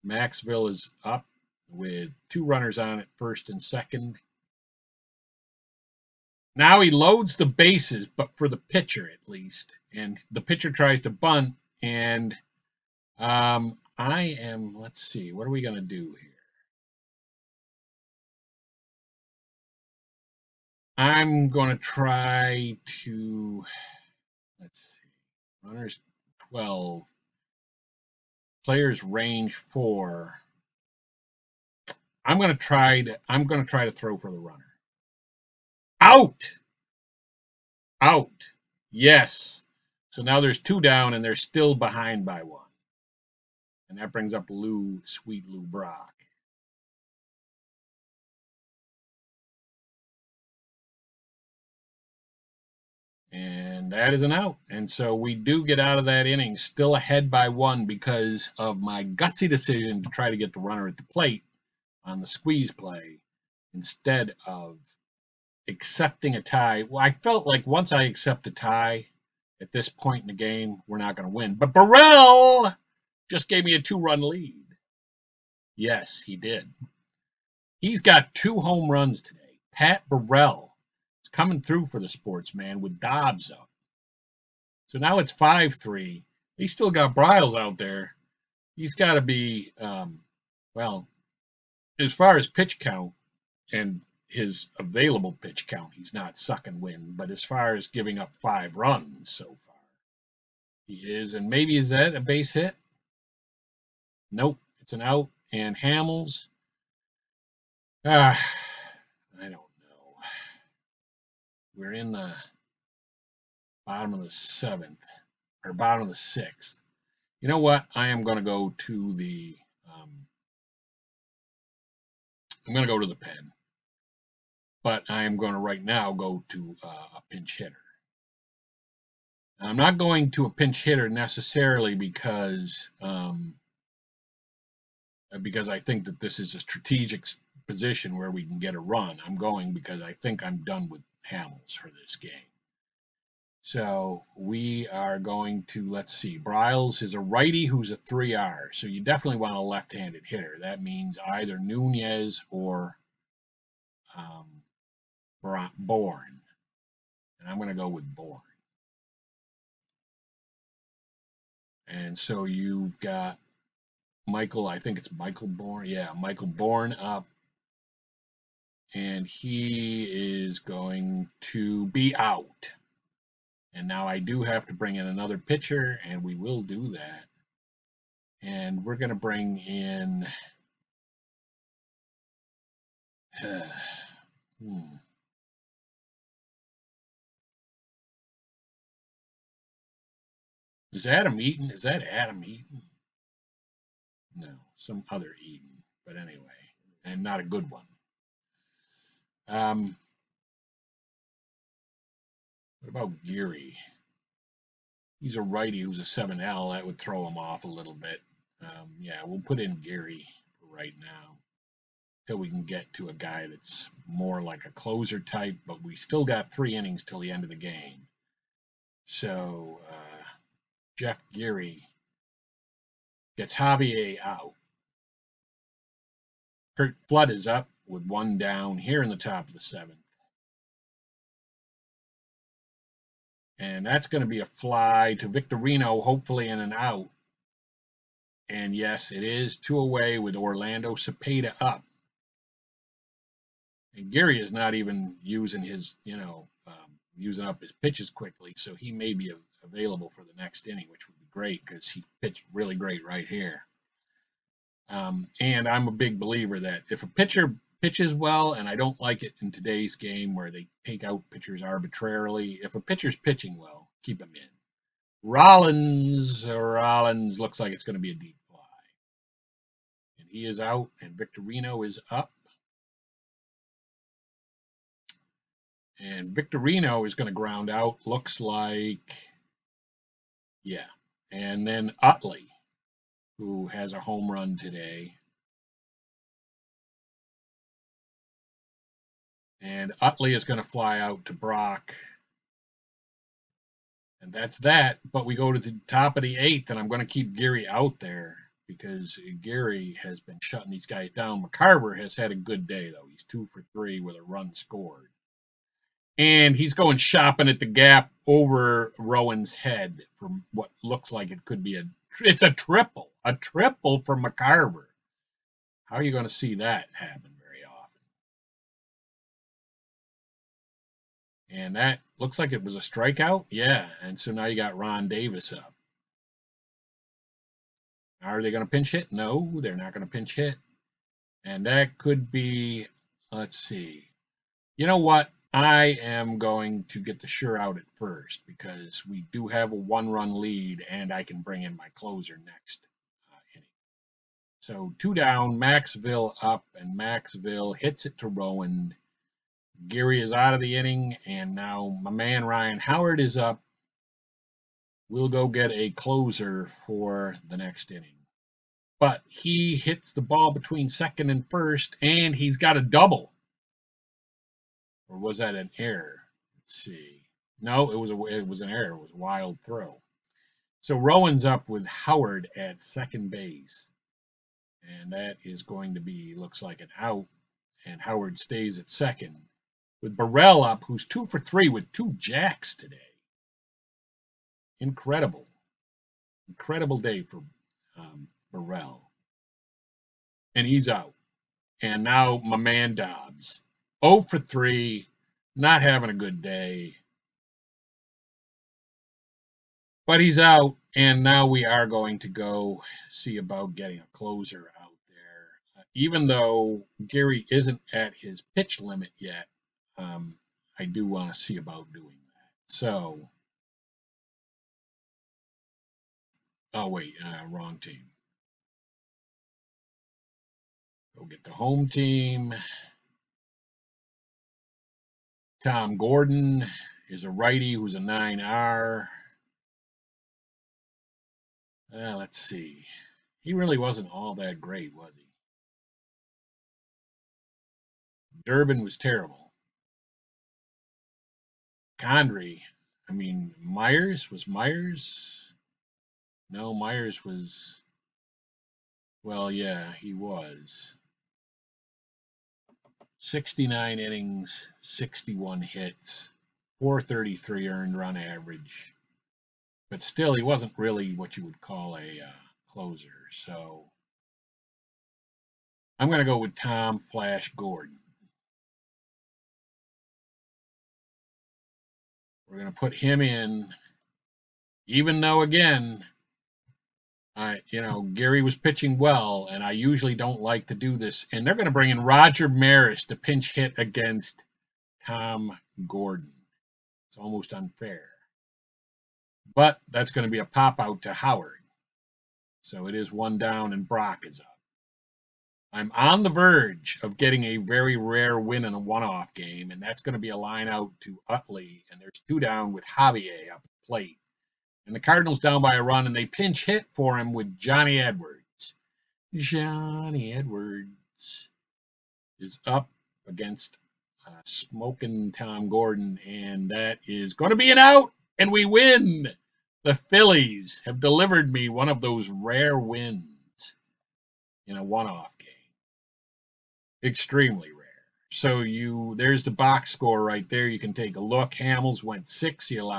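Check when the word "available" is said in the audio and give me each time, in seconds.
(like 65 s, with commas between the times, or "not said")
94 s, 249 s.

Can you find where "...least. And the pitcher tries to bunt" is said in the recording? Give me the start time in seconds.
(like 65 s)
9 s.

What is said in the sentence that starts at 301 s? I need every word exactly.
McCarver has had a good day, though.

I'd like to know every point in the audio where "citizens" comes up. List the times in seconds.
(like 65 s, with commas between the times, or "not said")
not said.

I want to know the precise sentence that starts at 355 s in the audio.
We'll go get a closer for the next inning.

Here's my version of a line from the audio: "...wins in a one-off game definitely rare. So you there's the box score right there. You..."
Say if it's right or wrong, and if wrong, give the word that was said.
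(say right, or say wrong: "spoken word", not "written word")
wrong: "extremely", not "definitely".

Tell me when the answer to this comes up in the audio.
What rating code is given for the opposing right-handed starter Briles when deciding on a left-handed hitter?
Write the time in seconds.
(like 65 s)
147 s.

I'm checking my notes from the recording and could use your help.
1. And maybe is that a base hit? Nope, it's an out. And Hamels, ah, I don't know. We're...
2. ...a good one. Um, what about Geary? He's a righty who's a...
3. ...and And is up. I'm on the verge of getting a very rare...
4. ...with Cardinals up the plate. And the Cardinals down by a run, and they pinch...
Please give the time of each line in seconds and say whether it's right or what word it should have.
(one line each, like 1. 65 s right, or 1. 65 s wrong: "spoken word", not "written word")
1. 101 s right
2. 197 s right
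3. 493 s wrong: "Brock", not "And"
4. 502 s wrong: "Javier", not "Cardinals".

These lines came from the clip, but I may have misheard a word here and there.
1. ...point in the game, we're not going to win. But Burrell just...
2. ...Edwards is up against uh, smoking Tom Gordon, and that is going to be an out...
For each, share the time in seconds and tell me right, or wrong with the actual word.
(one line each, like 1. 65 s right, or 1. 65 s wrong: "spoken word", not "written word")
1. 69 s right
2. 510 s right.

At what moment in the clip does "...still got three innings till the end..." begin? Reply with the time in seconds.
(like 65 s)
215 s.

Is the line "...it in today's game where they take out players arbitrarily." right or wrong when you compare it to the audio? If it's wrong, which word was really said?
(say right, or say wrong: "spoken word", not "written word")
wrong: "pitchers", not "players".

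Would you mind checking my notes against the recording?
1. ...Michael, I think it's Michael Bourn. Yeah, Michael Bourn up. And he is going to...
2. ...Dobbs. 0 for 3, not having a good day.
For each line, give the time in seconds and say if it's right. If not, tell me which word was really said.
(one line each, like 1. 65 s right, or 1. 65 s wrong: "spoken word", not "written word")
1. 164 s right
2. 392 s right.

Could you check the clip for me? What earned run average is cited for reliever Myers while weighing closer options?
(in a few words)
4.33.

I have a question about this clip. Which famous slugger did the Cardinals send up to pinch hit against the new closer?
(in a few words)
Roger Maris.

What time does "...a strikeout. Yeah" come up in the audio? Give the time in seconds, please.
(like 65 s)
322 s.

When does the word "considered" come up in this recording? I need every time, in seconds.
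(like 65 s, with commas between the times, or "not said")
not said.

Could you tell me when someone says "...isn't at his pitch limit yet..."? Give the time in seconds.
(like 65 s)
407 s.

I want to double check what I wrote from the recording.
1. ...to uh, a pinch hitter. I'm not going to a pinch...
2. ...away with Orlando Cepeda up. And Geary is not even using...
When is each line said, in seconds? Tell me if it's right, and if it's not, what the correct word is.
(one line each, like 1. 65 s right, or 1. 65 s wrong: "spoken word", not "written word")
1. 126 s right
2. 239 s right.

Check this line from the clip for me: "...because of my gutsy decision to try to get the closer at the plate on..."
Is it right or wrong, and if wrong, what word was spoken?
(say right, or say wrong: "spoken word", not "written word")
wrong: "runner", not "closer".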